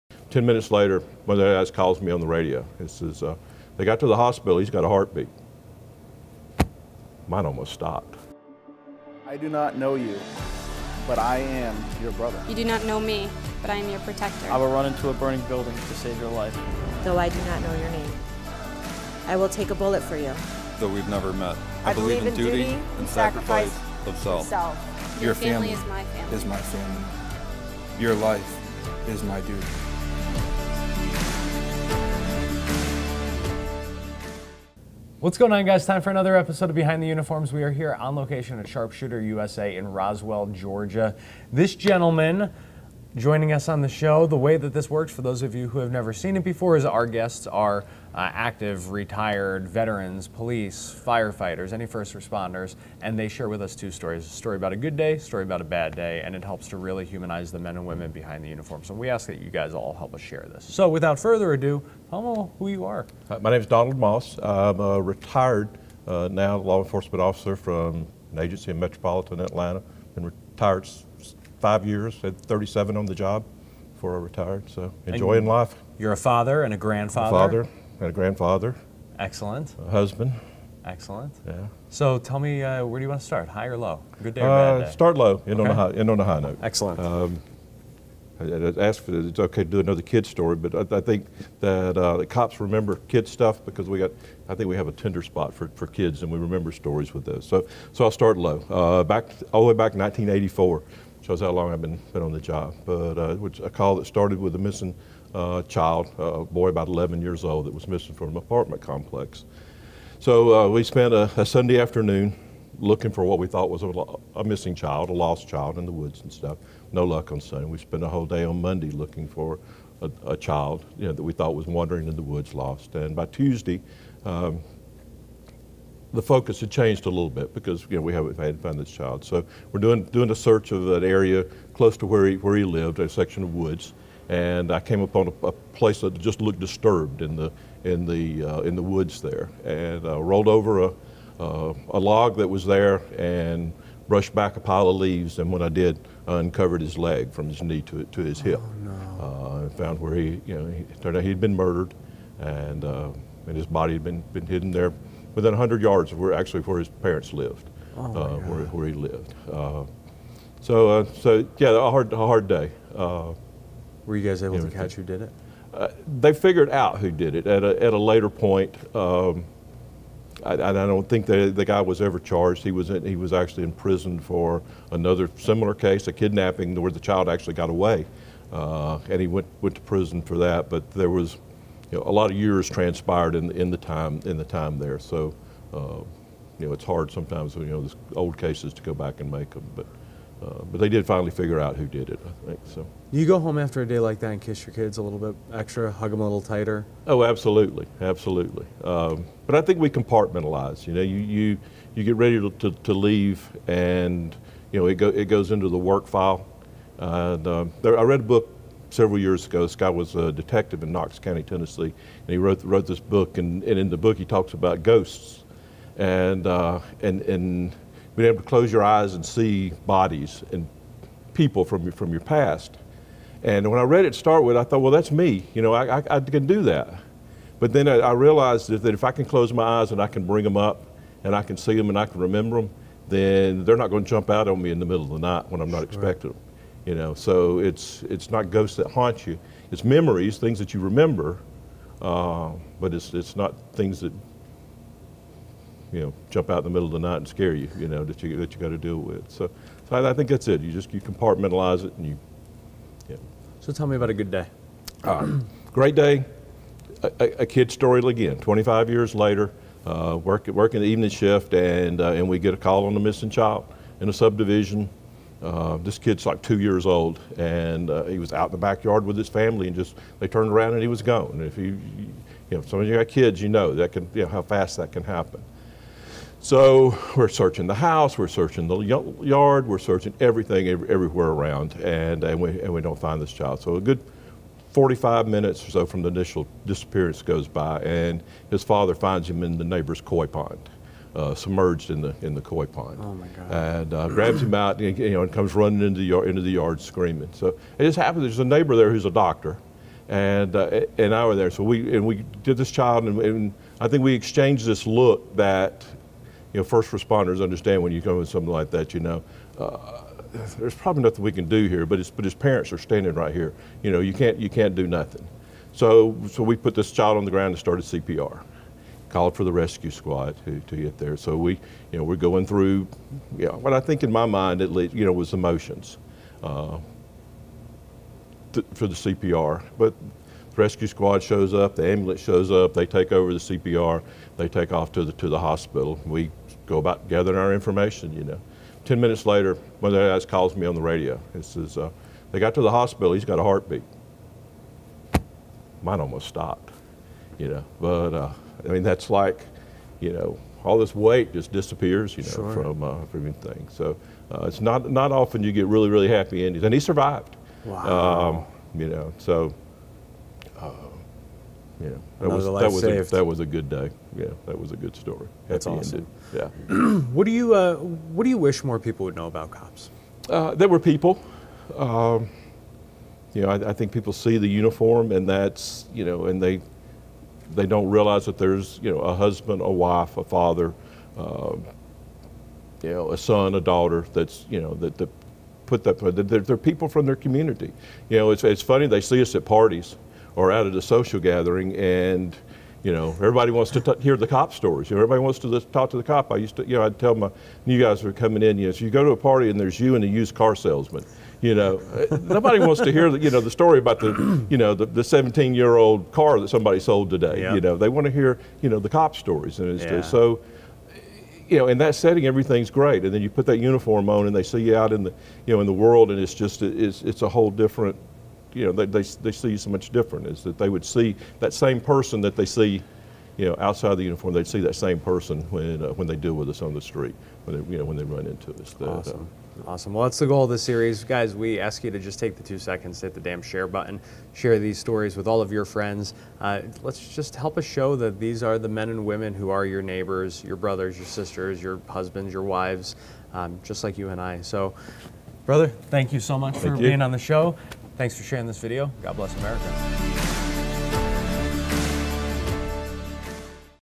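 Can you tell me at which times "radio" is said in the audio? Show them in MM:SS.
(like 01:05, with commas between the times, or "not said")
00:02, 05:40.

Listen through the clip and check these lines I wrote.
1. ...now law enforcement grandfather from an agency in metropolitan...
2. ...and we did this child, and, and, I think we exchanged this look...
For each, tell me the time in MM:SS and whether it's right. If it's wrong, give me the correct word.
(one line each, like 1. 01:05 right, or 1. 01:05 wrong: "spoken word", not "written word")
1. 01:06 wrong: "officer", not "grandfather"
2. 05:01 right.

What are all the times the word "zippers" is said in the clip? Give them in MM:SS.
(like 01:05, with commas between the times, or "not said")
not said.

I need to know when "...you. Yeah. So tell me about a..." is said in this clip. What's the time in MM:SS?
04:12.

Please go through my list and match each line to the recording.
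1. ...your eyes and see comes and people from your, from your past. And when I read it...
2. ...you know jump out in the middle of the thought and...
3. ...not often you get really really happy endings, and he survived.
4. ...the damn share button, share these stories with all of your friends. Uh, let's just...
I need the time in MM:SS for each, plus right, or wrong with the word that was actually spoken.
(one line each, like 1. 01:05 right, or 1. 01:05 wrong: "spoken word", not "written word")
1. 03:38 wrong: "bodies", not "comes"
2. 04:05 wrong: "night", not "thought"
3. 05:54 right
4. 07:13 right.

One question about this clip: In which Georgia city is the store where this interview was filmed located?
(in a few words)
Roswell.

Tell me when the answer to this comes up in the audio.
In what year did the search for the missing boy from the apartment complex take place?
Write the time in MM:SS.
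01:39.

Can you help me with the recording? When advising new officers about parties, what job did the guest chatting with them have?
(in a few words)
Used car salesman.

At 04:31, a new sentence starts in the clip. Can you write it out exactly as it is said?
And if you, you know, if some of you got kids, you know that can, you know, how fast that can happen.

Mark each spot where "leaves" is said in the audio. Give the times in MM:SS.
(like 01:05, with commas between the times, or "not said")
02:24, 03:22.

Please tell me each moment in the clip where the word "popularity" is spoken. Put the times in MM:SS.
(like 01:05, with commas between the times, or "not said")
not said.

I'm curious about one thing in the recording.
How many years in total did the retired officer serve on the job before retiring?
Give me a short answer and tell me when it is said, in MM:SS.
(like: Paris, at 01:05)
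37, at 01:12.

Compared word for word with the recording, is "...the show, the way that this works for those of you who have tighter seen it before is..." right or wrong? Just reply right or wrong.
wrong.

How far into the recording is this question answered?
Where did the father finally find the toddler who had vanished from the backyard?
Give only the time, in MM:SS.
04:49.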